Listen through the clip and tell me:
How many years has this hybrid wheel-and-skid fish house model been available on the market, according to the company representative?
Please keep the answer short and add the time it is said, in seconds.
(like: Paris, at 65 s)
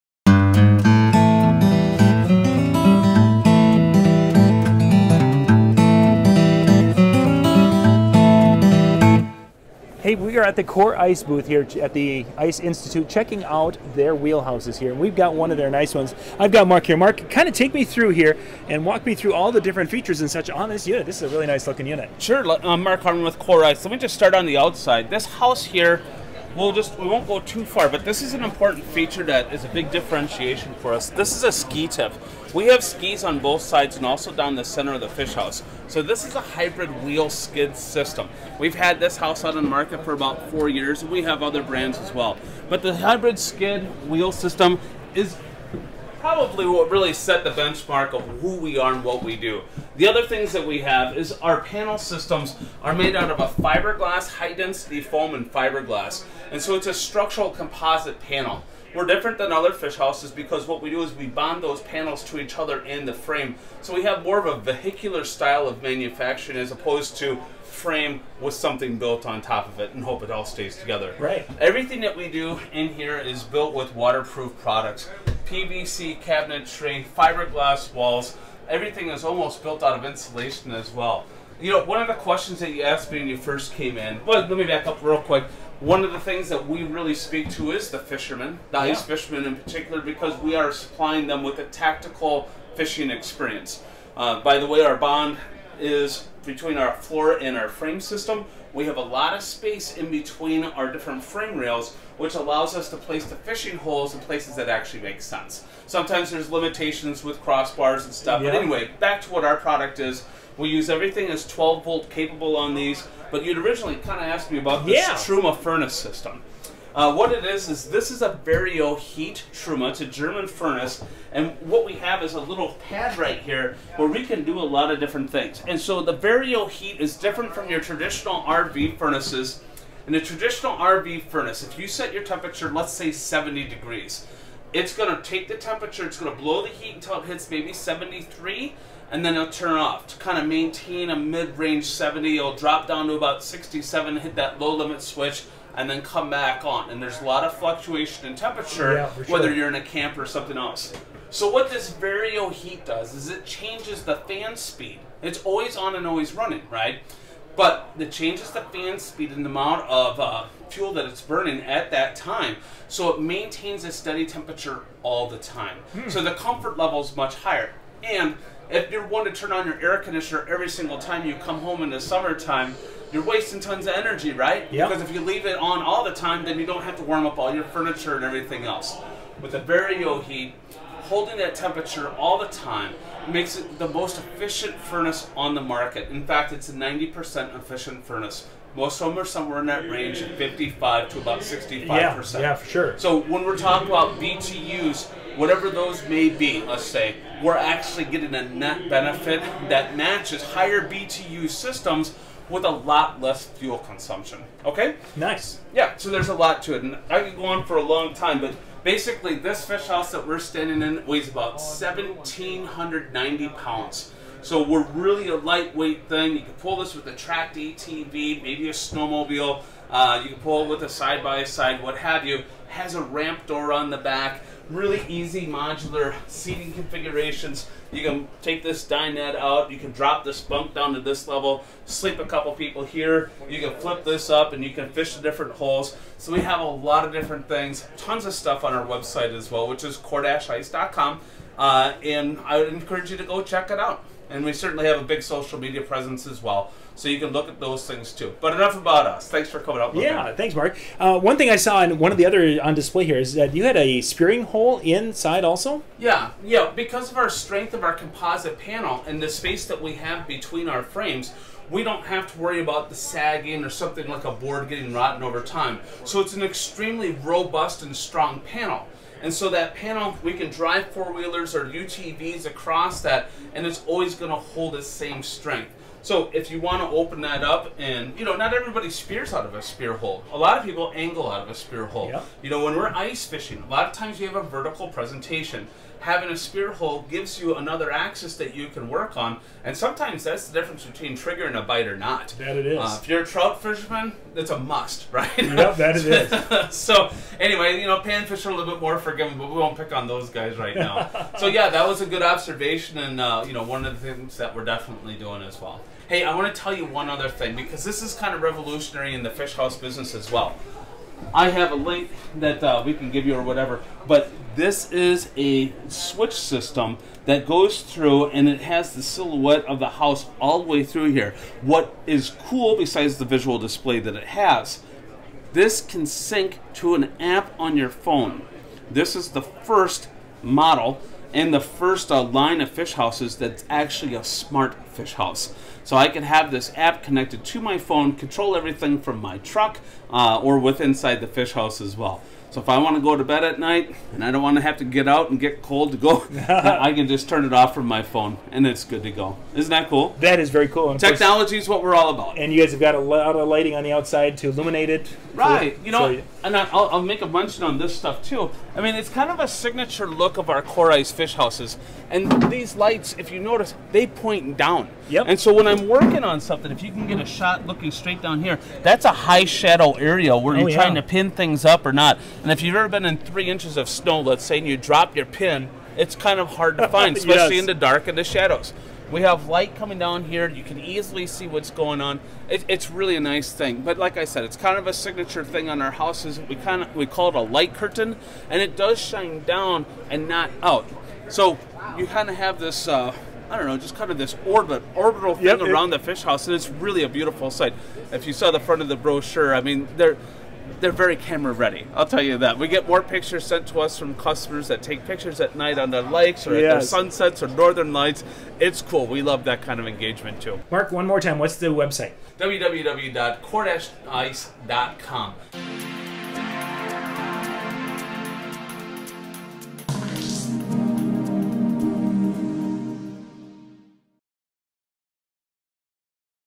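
4, at 40 s.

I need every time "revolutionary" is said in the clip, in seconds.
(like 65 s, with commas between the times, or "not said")
308 s.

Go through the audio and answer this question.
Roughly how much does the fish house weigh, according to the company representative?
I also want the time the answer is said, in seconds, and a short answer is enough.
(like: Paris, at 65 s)
1,790 pounds, at 211 s.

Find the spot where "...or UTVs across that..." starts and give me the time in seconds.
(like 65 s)
271 s.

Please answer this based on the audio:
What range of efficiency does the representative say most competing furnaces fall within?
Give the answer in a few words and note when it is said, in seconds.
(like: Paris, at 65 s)
55 to 65%, at 190 s.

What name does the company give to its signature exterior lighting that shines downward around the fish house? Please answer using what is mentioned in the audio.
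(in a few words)
light curtain.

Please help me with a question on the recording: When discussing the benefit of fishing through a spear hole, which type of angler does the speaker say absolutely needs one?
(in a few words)
trout fisherman.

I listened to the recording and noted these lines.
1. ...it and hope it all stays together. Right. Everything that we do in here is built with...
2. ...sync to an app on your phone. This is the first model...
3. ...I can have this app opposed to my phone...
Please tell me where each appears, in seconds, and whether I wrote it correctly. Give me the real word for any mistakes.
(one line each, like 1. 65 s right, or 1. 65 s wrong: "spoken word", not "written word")
1. 69 s right
2. 326 s right
3. 335 s wrong: "connected", not "opposed".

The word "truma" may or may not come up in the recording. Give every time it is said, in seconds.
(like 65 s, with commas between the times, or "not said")
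115 s, 119 s.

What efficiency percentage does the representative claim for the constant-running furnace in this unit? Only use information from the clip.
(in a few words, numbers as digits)
90%.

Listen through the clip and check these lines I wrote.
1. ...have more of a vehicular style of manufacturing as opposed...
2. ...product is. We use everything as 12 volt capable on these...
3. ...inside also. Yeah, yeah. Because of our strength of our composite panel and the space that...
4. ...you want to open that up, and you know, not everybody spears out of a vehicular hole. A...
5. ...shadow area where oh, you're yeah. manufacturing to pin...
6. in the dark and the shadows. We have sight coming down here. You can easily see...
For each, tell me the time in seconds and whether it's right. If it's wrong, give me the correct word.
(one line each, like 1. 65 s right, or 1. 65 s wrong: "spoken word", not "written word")
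1. 64 s right
2. 109 s right
3. 254 s right
4. 276 s wrong: "spear", not "vehicular"
5. 369 s wrong: "trying", not "manufacturing"
6. 377 s wrong: "light", not "sight".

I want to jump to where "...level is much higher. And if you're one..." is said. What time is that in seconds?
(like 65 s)
166 s.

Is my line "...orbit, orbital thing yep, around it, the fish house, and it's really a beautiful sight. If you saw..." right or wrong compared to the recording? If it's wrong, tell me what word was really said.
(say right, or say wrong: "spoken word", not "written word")
right.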